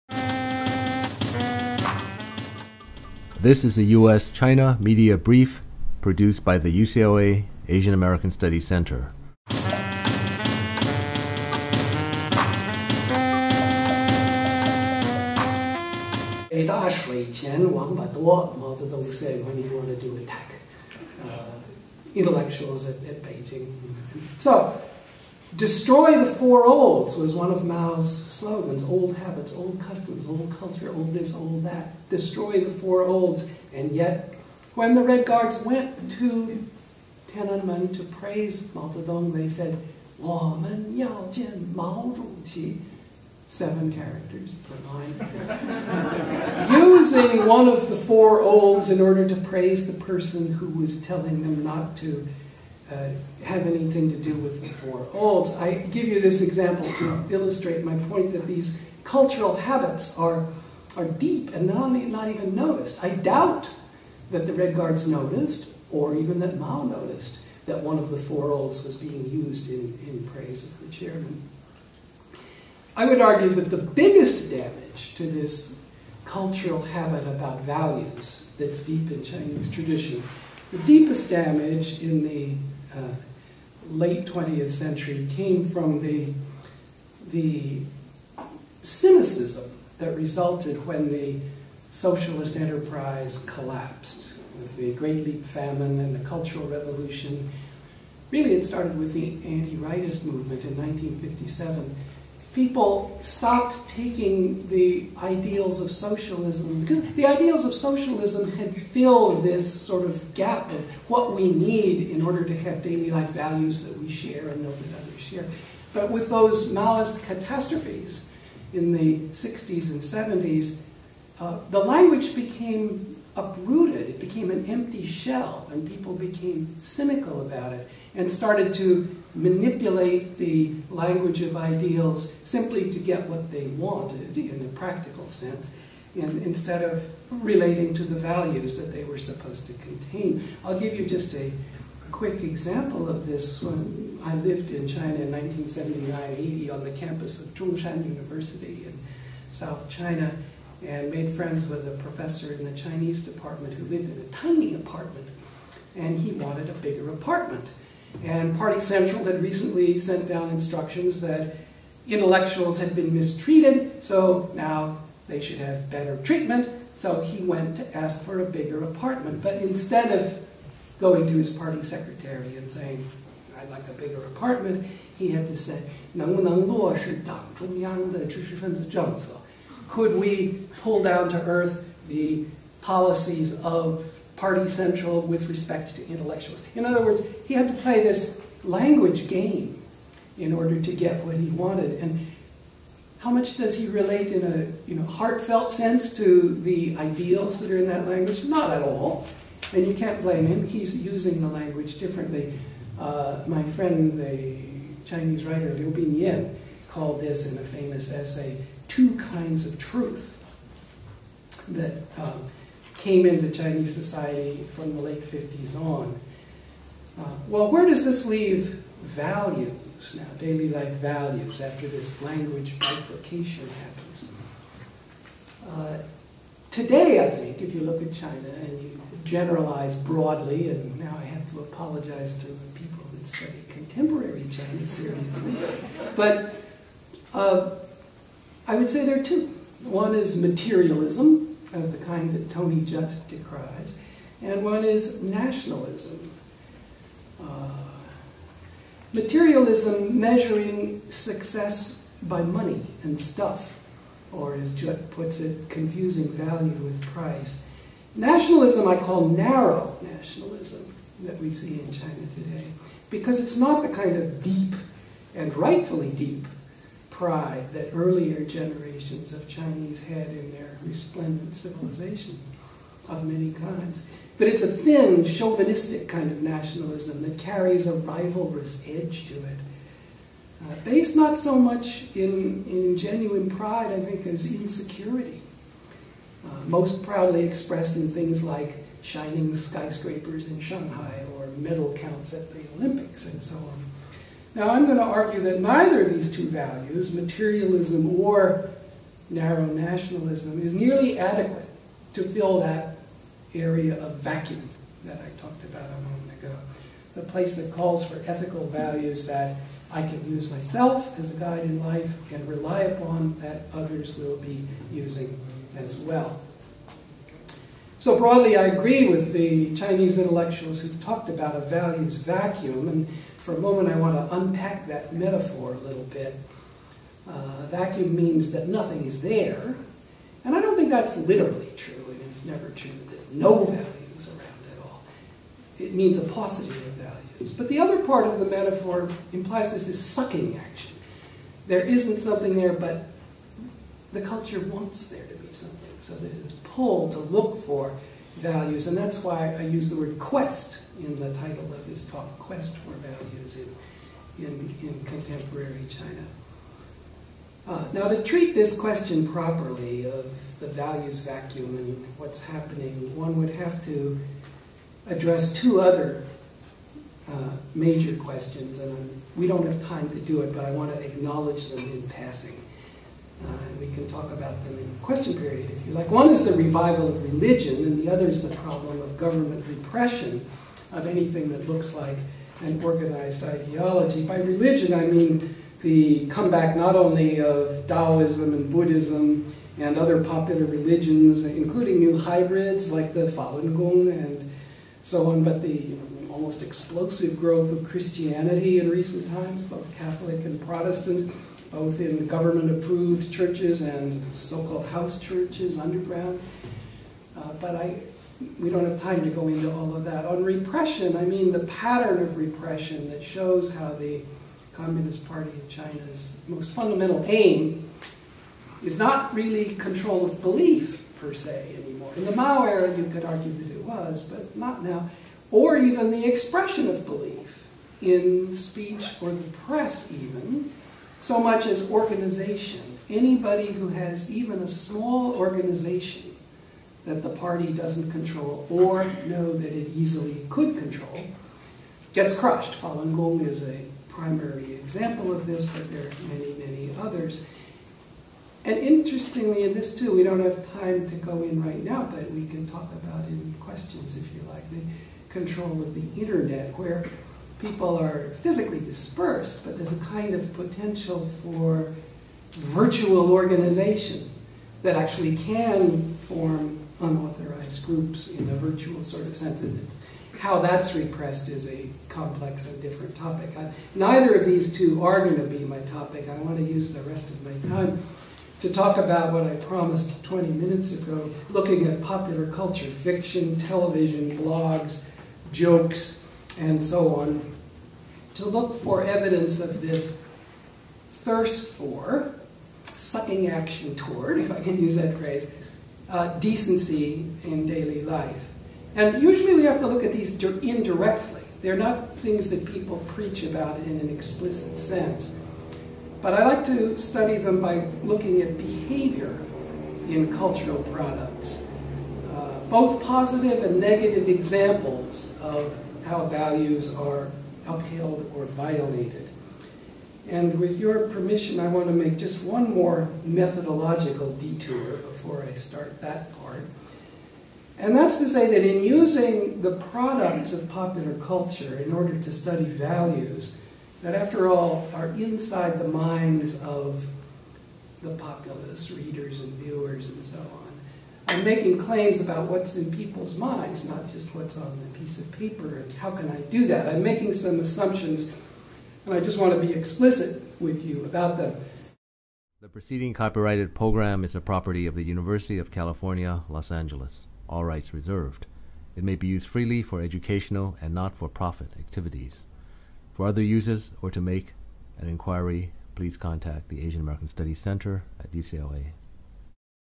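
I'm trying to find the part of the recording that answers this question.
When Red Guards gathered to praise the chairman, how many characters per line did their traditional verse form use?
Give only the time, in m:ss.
0:43.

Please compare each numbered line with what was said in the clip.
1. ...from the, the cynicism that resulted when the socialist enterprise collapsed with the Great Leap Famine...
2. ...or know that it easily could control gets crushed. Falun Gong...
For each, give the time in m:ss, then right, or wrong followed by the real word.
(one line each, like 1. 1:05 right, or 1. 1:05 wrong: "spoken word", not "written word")
1. 1:25 right
2. 7:18 right.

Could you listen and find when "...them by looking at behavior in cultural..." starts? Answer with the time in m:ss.
8:27.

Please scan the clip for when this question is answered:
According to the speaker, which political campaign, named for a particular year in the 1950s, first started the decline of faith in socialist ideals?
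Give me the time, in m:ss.
1:39.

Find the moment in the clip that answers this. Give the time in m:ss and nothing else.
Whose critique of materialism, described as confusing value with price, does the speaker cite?
4:02.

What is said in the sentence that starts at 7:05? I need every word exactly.
Or even the expression of belief in speech or the press, even so much as organization.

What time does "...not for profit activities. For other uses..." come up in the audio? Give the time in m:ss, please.
9:20.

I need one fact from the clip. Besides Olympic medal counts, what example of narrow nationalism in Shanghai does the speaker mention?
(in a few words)
shining skyscrapers.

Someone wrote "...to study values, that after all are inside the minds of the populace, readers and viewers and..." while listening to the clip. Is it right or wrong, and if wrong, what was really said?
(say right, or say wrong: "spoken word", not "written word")
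right.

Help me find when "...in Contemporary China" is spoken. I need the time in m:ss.
5:54.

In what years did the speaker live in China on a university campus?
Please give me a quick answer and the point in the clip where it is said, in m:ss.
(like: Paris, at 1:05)
1979-80, at 2:25.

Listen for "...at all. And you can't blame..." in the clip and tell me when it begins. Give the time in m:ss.
3:18.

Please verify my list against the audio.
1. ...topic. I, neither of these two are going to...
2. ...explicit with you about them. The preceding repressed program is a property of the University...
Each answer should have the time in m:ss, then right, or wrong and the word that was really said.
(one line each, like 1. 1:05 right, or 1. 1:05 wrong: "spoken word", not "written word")
1. 7:53 right
2. 9:09 wrong: "copyrighted", not "repressed".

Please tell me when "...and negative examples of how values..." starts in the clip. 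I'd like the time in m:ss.
8:33.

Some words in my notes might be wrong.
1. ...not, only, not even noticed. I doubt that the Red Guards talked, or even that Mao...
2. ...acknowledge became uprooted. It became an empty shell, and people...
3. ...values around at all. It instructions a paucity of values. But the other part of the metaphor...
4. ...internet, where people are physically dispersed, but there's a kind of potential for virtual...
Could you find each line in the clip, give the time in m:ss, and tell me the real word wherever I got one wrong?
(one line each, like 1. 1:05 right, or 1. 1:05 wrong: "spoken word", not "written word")
1. 1:01 wrong: "noticed", not "talked"
2. 2:01 wrong: "language", not "acknowledge"
3. 5:33 wrong: "means", not "instructions"
4. 7:36 right.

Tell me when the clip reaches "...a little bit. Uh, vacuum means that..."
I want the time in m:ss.
5:25.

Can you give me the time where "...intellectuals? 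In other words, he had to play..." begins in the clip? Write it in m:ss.
3:06.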